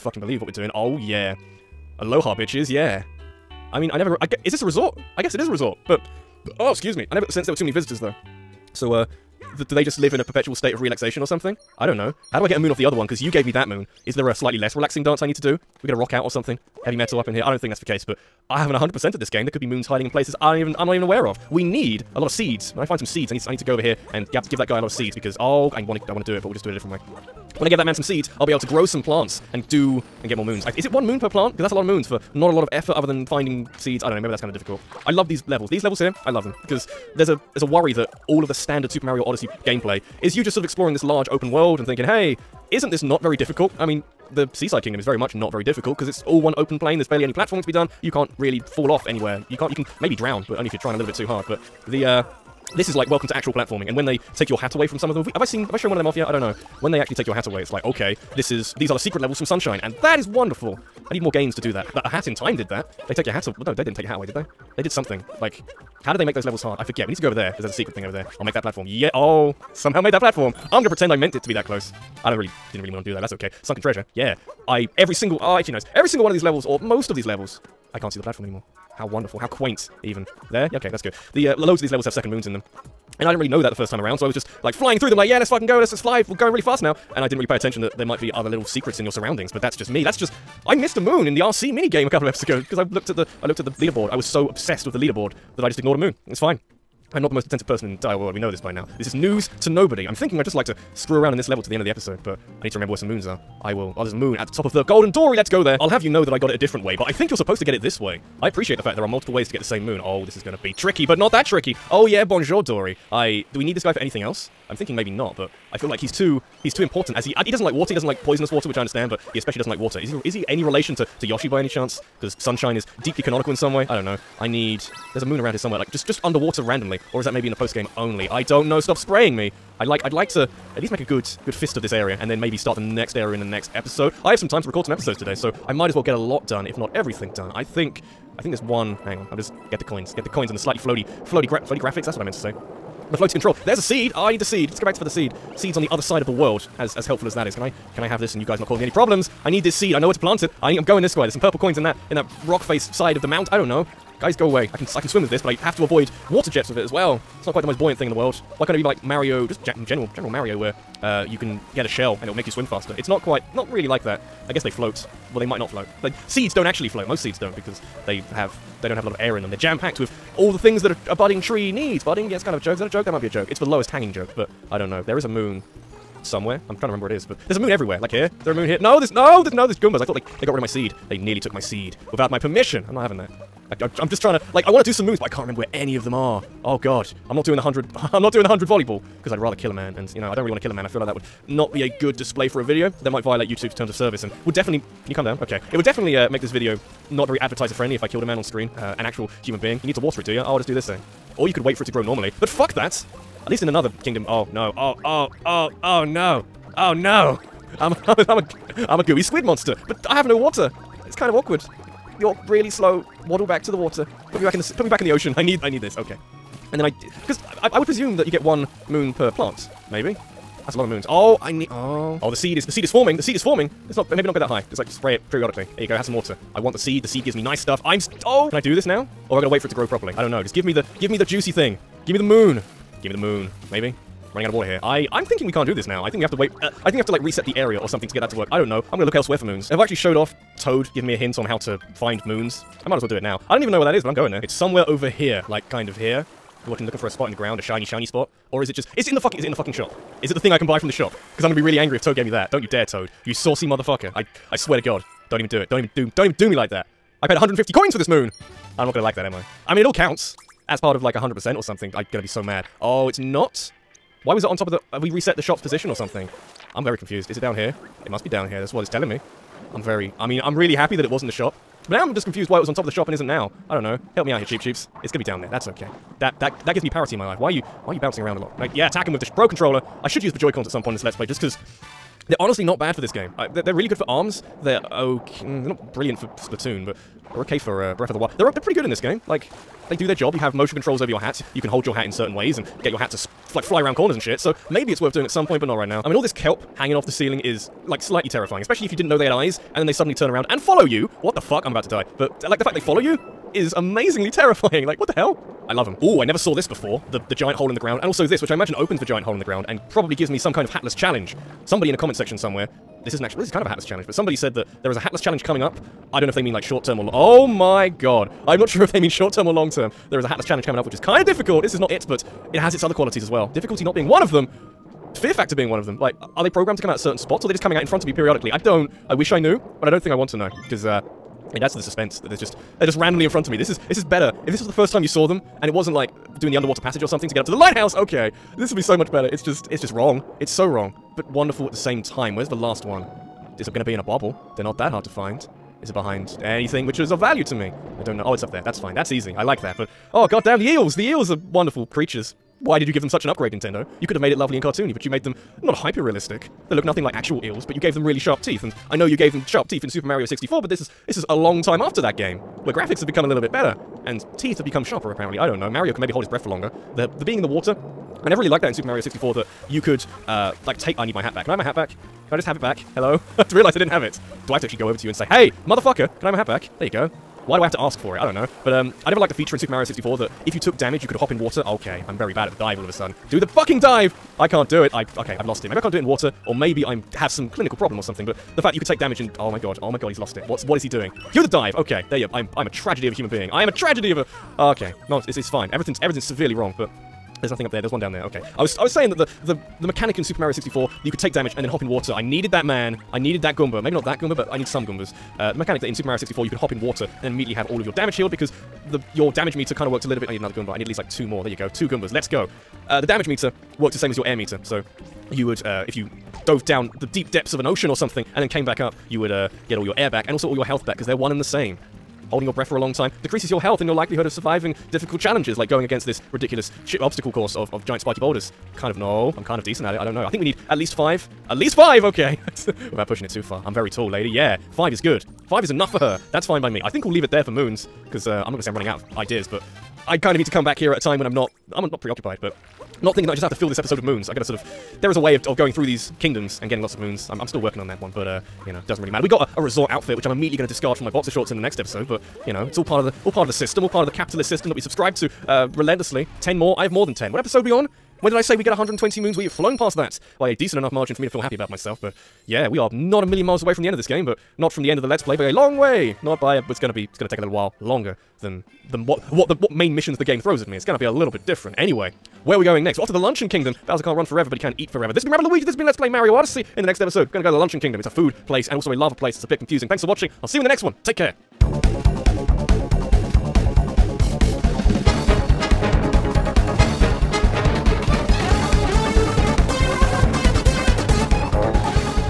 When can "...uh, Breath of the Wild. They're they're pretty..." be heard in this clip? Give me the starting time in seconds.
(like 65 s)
287 s.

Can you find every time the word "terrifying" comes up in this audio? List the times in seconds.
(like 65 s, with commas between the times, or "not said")
298 s, 304 s.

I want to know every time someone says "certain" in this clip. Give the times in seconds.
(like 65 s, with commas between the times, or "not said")
292 s, 326 s.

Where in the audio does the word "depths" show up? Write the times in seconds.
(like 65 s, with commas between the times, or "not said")
417 s.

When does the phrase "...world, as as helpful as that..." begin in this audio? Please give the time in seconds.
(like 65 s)
146 s.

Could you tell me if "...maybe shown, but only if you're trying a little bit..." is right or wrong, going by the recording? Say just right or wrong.
wrong.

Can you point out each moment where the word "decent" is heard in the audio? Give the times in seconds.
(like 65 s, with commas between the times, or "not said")
429 s, 460 s.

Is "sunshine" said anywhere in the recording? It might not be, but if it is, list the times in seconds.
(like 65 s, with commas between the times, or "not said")
59 s, 122 s.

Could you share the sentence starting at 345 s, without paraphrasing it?
Is it behind anything which is of value to me?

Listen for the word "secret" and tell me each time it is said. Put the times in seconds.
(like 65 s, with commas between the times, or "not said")
58 s, 67 s, 88 s.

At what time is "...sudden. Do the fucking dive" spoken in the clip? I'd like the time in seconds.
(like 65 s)
382 s.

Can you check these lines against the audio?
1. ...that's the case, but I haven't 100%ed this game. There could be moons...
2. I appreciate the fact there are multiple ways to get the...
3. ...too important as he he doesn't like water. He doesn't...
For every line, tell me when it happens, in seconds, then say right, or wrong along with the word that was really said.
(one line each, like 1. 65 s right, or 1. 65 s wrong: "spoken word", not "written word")
1. 17 s right
2. 108 s right
3. 116 s right.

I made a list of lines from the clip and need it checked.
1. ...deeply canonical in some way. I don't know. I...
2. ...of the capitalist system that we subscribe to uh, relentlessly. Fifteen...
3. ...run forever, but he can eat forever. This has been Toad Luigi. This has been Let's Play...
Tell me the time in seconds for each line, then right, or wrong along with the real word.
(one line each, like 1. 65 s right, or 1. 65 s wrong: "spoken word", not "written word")
1. 123 s right
2. 454 s wrong: "Ten", not "Fifteen"
3. 474 s wrong: "Rabbid", not "Toad".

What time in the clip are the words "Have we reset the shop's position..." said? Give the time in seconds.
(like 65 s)
264 s.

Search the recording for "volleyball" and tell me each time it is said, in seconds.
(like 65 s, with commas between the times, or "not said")
188 s.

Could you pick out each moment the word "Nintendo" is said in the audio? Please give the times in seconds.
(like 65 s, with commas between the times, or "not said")
353 s.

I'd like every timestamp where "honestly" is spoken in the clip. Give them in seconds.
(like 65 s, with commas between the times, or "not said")
282 s.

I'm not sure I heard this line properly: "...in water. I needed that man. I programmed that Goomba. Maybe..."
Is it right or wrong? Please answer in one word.
wrong.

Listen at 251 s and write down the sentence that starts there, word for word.
Because I'm going to be really angry if Toad gave me that.